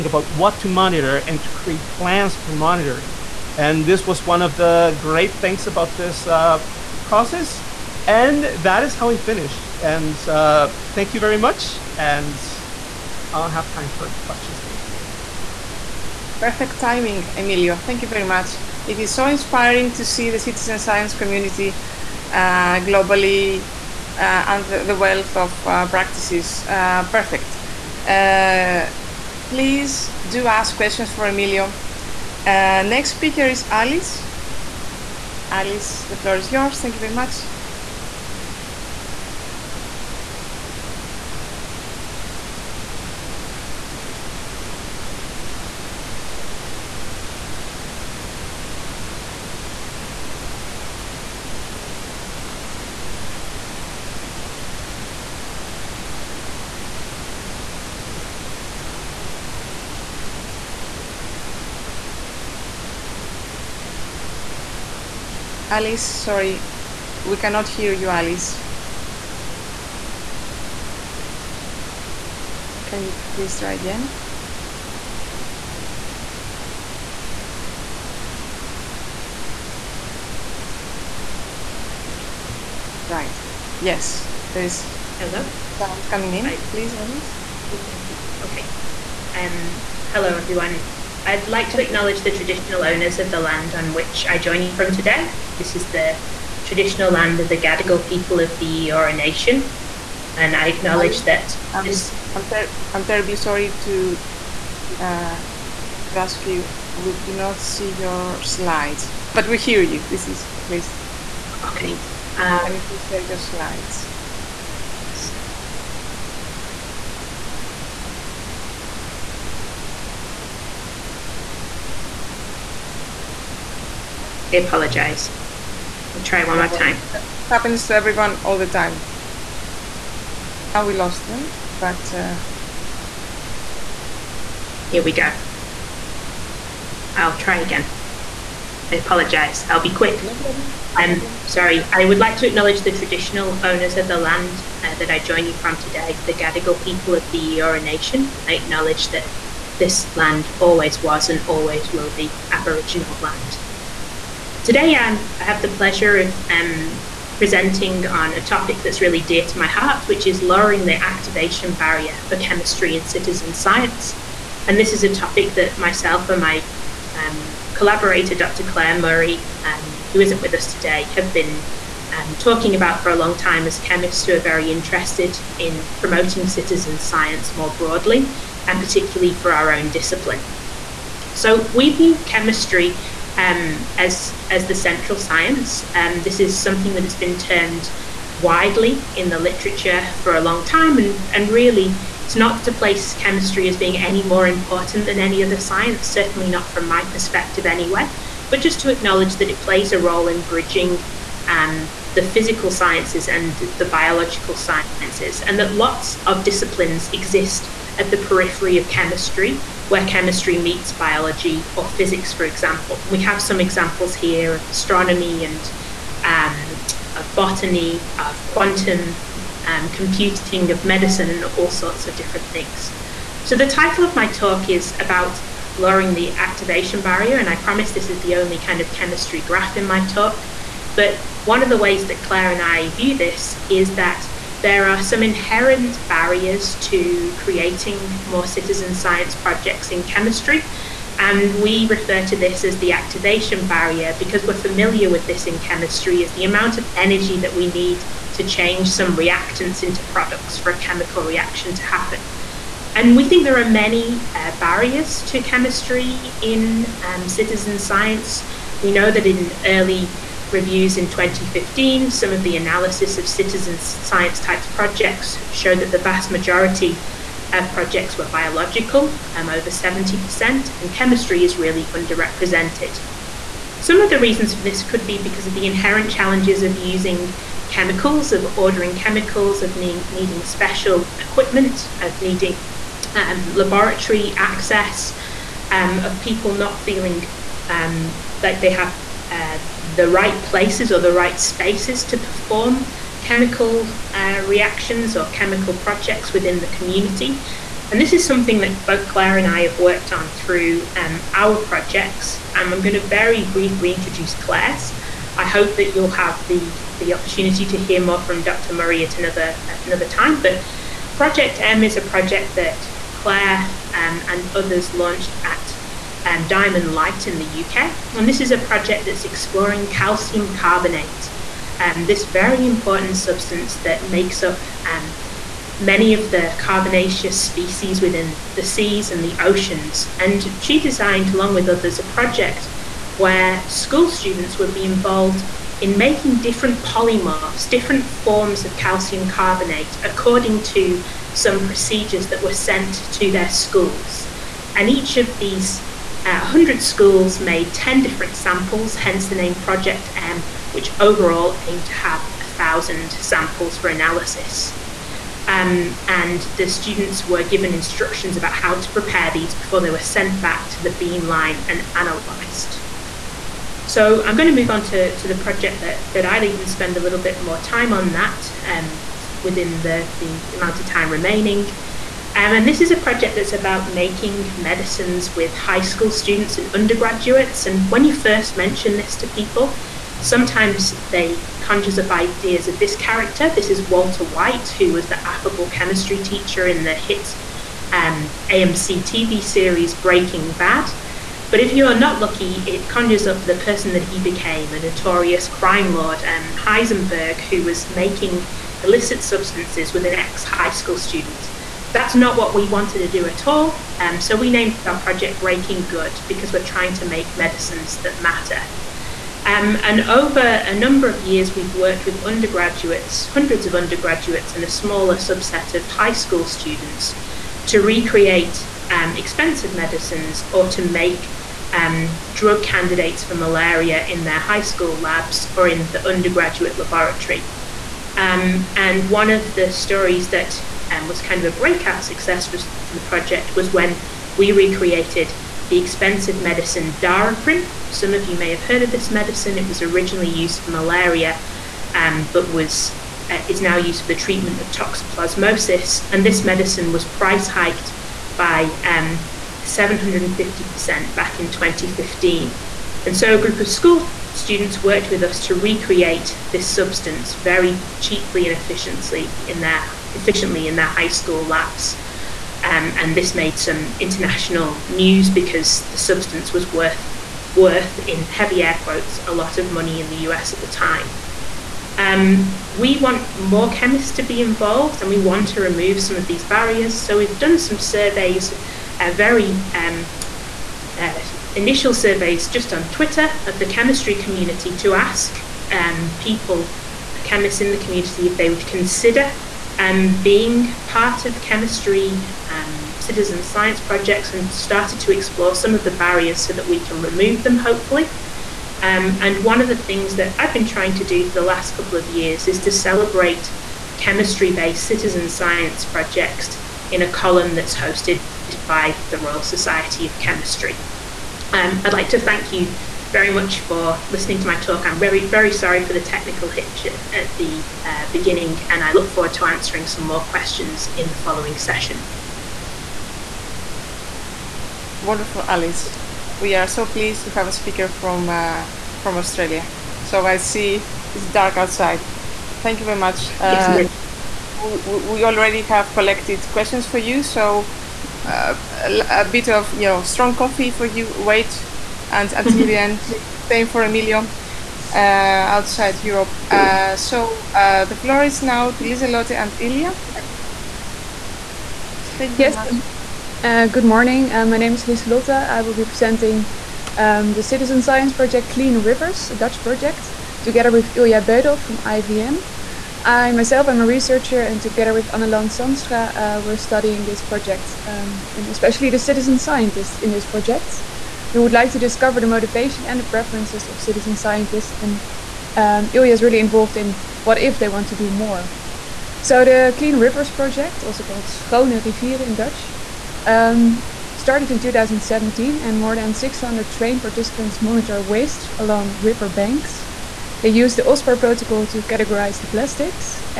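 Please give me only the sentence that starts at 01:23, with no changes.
Yes, there's hello sound coming in.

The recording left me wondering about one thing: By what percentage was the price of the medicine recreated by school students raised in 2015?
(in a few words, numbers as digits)
750%.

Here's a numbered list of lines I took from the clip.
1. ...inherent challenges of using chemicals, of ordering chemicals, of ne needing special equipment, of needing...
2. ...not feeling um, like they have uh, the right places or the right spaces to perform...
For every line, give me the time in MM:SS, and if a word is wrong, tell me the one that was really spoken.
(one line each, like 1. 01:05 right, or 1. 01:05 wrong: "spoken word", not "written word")
1. 04:35 right
2. 04:46 right.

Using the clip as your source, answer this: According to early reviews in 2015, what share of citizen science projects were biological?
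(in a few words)
over 70%.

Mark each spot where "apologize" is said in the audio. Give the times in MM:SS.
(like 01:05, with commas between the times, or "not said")
02:04, 02:18.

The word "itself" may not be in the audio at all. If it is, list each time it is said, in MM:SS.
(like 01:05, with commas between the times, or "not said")
not said.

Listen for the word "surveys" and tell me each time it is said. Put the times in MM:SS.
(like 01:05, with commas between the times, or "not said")
07:57, 08:01.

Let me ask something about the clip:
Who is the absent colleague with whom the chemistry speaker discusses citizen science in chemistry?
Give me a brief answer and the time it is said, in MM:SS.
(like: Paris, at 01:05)
Dr. Claire Murray, at 02:48.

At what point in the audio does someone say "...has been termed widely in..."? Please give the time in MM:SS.
03:07.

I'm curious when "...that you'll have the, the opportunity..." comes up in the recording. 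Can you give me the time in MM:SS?
05:05.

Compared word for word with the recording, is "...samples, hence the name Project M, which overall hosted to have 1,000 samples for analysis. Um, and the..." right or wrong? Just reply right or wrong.
wrong.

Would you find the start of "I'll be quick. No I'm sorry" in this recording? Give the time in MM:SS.
02:19.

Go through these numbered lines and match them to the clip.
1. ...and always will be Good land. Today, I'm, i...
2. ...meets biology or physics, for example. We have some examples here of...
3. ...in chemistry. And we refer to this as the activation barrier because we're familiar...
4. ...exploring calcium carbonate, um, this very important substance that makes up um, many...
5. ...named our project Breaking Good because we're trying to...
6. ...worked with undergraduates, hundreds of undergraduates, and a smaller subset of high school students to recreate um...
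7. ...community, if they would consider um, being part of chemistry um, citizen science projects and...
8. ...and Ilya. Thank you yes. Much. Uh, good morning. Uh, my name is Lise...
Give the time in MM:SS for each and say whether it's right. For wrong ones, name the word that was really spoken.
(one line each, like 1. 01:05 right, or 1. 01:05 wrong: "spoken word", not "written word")
1. 02:31 wrong: "Aboriginal", not "Good"
2. 03:30 right
3. 03:59 right
4. 05:19 right
5. 06:44 right
6. 06:51 right
7. 08:07 right
8. 09:09 right.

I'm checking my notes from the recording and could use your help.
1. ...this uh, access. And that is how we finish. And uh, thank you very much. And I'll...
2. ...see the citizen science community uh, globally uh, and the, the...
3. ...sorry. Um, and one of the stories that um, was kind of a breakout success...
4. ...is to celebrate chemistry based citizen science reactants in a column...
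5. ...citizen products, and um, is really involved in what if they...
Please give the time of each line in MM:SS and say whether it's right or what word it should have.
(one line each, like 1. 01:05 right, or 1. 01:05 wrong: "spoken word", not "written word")
1. 00:05 wrong: "process", not "access"
2. 00:20 right
3. 07:06 wrong: "laboratory", not "sorry"
4. 08:22 wrong: "projects", not "reactants"
5. 09:33 wrong: "scientists", not "products".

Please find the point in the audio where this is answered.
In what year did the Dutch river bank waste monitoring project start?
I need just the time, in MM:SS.
09:44.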